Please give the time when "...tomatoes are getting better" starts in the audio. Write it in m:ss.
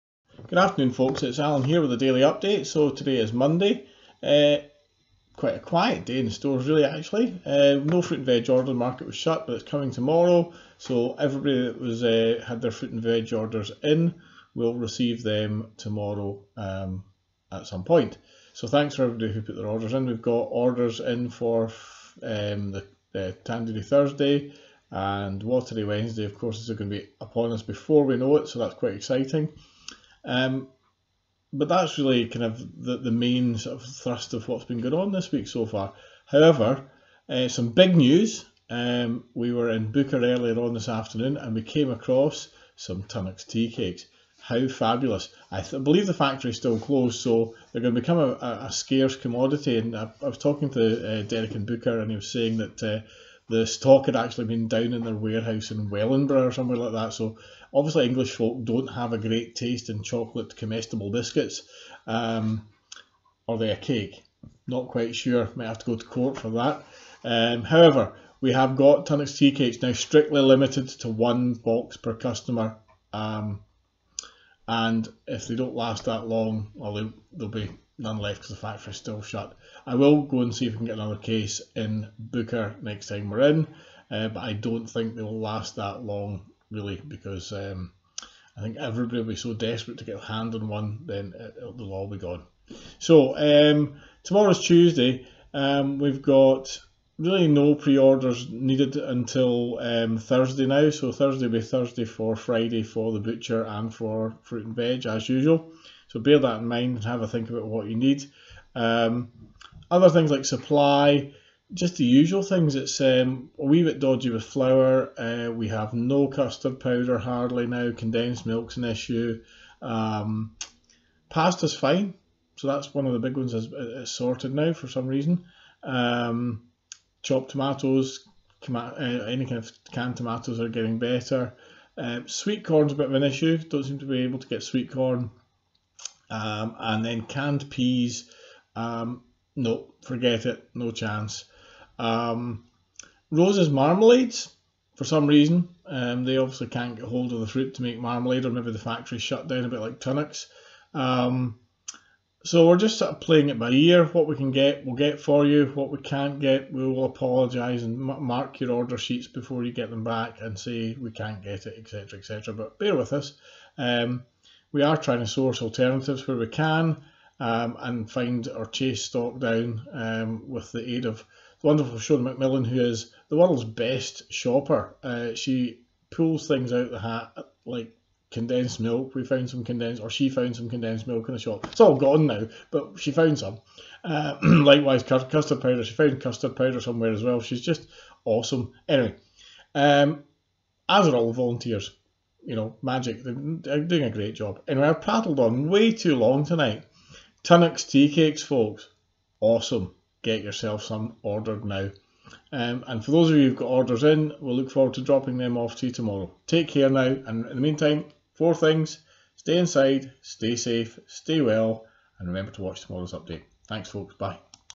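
2:10.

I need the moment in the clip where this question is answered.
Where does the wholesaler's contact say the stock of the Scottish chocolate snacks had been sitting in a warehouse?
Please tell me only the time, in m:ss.
0:55.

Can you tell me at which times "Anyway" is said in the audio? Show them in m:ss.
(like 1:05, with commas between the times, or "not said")
3:08, 3:14.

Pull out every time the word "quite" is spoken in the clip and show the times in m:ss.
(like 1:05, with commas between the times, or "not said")
0:05, 0:28, 1:04.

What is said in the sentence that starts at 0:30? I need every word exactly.
Um, but that's really kind of the, the main sort of thrust of what's been going on this week so far.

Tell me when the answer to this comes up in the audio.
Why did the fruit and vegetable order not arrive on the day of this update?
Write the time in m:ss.
0:08.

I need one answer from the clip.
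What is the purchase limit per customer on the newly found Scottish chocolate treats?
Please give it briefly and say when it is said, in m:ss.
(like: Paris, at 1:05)
1 box, at 1:11.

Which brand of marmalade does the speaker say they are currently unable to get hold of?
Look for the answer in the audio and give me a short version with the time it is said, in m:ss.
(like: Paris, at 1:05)
Rose's, at 2:23.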